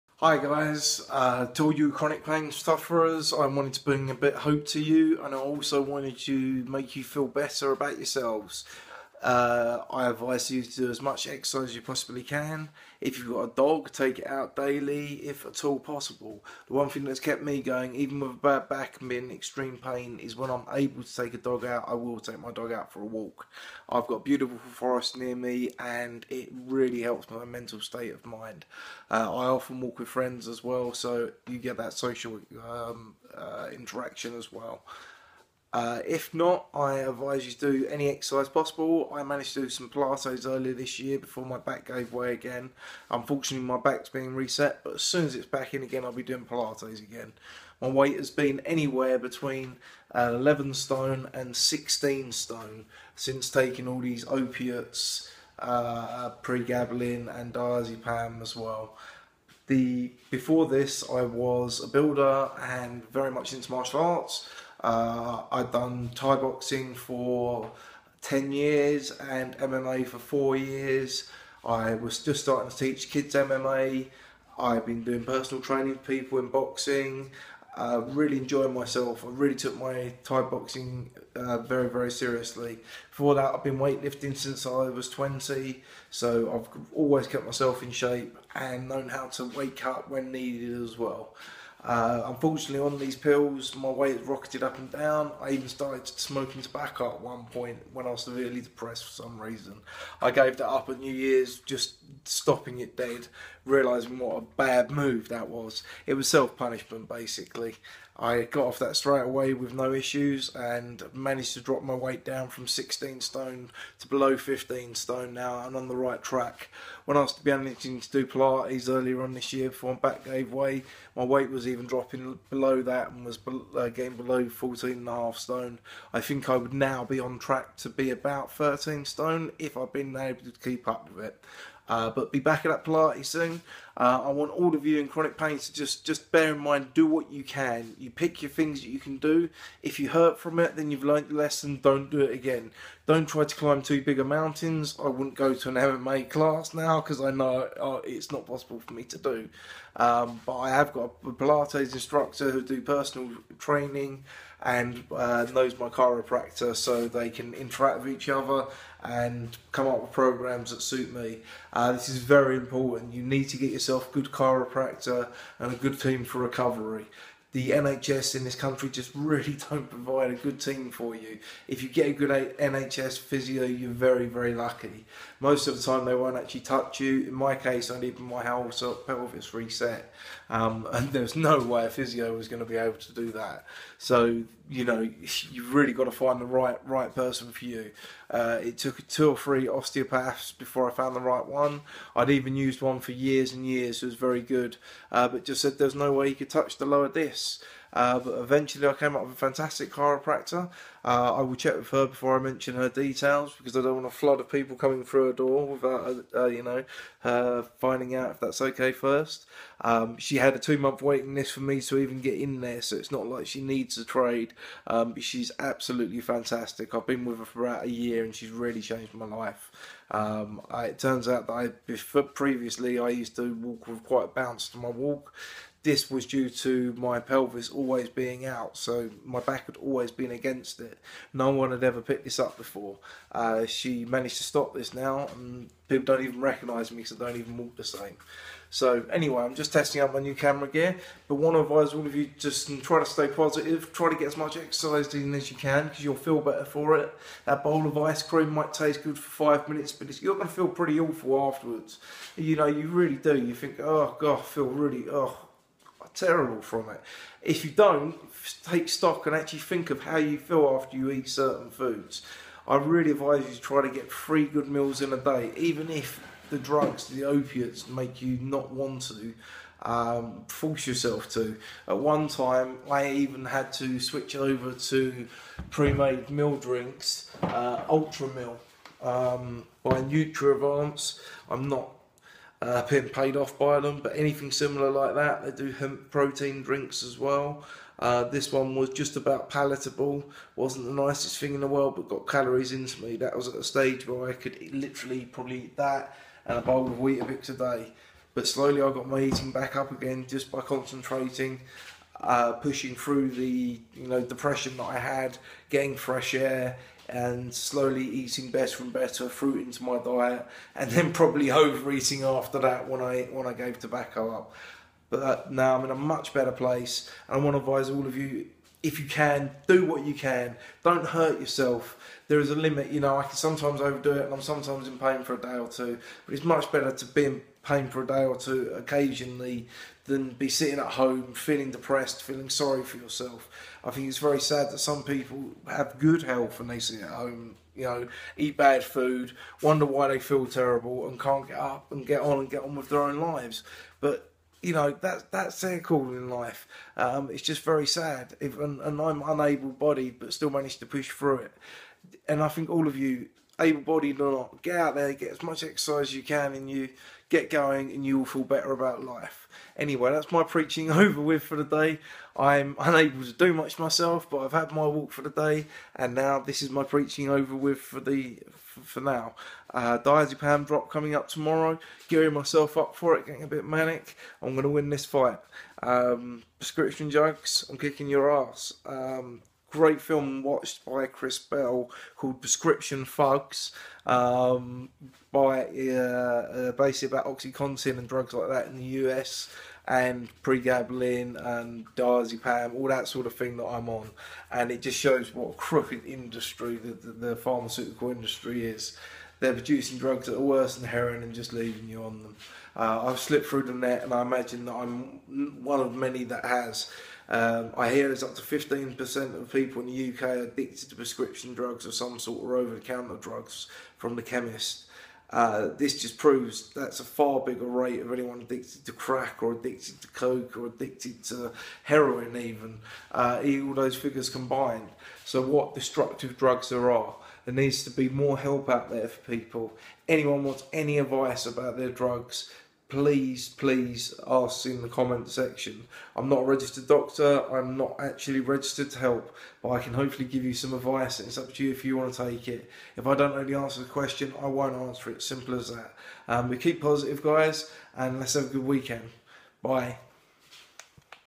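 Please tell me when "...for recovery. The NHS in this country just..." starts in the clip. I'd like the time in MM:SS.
02:46.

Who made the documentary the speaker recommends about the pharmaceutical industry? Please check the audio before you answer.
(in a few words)
Chris Bell.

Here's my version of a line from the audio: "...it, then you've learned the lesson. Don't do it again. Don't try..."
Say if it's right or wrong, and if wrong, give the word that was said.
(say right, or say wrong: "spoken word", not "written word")
right.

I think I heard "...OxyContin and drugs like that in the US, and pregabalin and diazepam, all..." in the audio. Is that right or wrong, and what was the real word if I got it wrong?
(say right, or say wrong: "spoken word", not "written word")
right.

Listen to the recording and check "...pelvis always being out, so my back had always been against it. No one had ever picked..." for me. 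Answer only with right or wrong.
right.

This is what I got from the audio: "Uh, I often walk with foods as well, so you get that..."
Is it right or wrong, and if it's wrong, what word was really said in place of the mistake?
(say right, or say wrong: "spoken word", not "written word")
wrong: "friends", not "foods".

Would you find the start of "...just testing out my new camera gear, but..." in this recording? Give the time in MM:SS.
03:59.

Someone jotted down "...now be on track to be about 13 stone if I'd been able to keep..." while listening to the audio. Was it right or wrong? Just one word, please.
right.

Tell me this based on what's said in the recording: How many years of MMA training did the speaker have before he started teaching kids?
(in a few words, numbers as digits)
4.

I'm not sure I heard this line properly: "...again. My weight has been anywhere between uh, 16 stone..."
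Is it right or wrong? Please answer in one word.
wrong.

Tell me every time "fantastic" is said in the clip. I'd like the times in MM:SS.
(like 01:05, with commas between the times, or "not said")
03:19, 03:36.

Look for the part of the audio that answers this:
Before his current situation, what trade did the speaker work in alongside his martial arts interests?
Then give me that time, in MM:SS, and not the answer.
01:01.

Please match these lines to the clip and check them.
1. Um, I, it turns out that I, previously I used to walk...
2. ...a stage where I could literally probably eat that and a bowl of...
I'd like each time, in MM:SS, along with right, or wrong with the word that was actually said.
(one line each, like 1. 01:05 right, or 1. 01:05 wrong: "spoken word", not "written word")
1. 03:40 right
2. 04:53 right.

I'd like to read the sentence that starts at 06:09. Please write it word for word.
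Uh, diazepam drop coming up tomorrow.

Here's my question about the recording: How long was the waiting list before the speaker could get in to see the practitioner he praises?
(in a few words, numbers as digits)
2 months.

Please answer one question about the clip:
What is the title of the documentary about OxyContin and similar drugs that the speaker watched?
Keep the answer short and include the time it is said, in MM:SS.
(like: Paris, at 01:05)
Prescription Thugs, at 06:22.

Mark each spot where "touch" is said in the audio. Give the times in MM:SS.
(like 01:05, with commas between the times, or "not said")
02:56, 03:16.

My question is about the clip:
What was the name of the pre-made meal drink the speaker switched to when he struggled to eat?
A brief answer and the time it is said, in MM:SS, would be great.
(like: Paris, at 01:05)
Ultra Meal, at 04:37.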